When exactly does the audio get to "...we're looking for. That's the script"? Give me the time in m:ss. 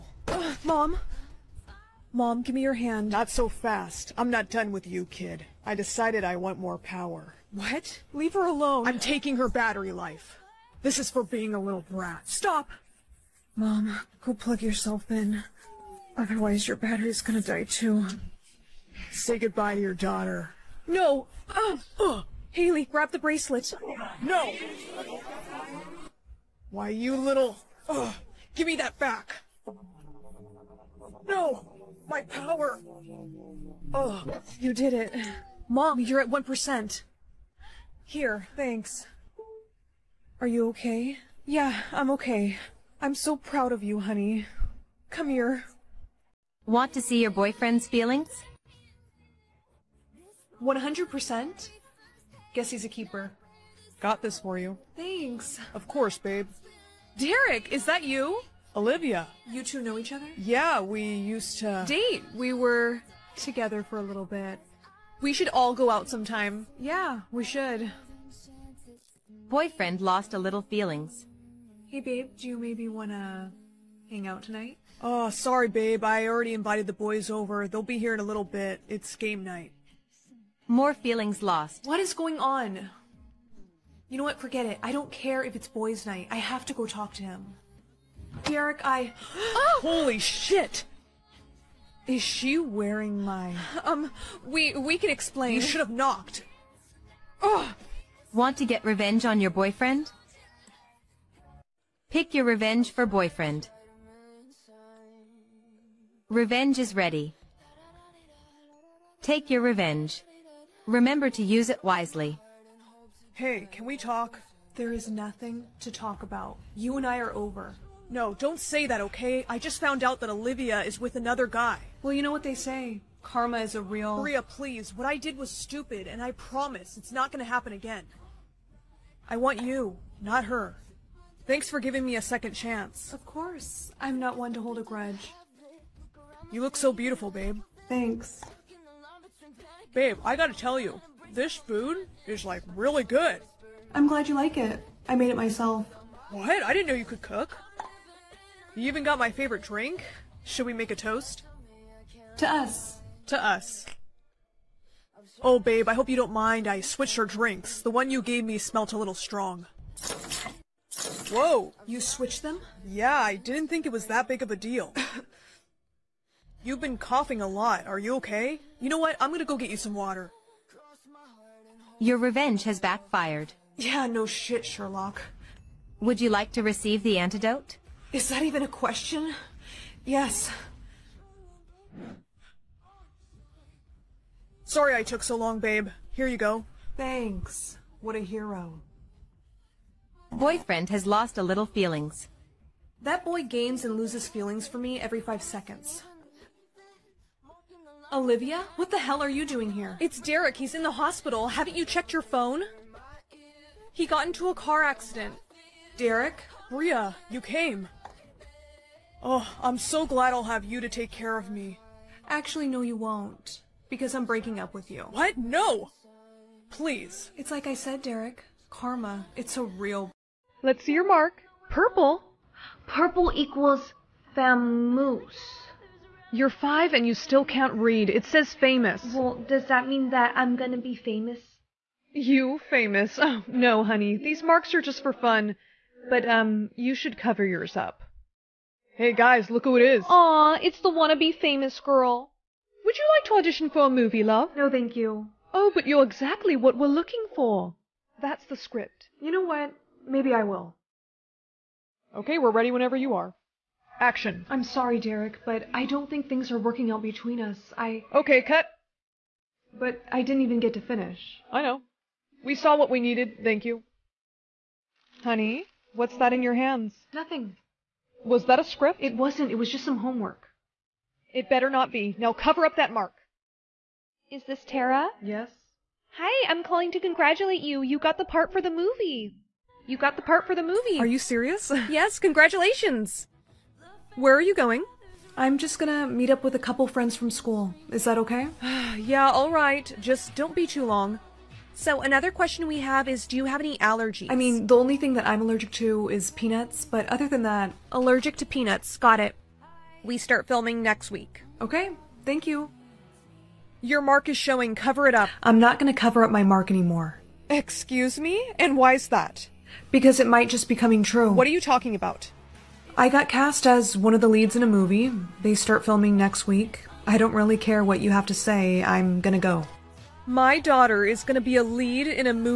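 4:06.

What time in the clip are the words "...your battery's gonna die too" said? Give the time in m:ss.
0:16.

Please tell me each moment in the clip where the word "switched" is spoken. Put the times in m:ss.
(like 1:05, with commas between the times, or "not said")
2:36, 2:42.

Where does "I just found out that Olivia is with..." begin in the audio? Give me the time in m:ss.
1:59.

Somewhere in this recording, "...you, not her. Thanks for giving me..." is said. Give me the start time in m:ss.
2:09.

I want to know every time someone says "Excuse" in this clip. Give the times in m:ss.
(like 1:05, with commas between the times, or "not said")
5:07.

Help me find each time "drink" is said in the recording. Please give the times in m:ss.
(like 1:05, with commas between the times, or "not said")
2:29, 2:37.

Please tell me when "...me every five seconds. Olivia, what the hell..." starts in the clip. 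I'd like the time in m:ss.
3:14.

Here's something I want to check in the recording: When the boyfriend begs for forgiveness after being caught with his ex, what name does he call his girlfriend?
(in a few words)
Maria.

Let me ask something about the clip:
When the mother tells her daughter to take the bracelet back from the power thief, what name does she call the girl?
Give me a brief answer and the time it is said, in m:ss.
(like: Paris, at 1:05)
Haley, at 0:22.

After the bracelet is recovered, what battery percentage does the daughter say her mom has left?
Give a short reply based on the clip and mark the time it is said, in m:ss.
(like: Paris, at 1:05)
1%, at 0:36.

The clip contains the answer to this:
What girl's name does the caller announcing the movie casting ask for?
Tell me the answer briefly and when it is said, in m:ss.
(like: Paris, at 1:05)
Tara, at 4:34.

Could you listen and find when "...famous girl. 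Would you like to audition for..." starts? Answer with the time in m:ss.
4:01.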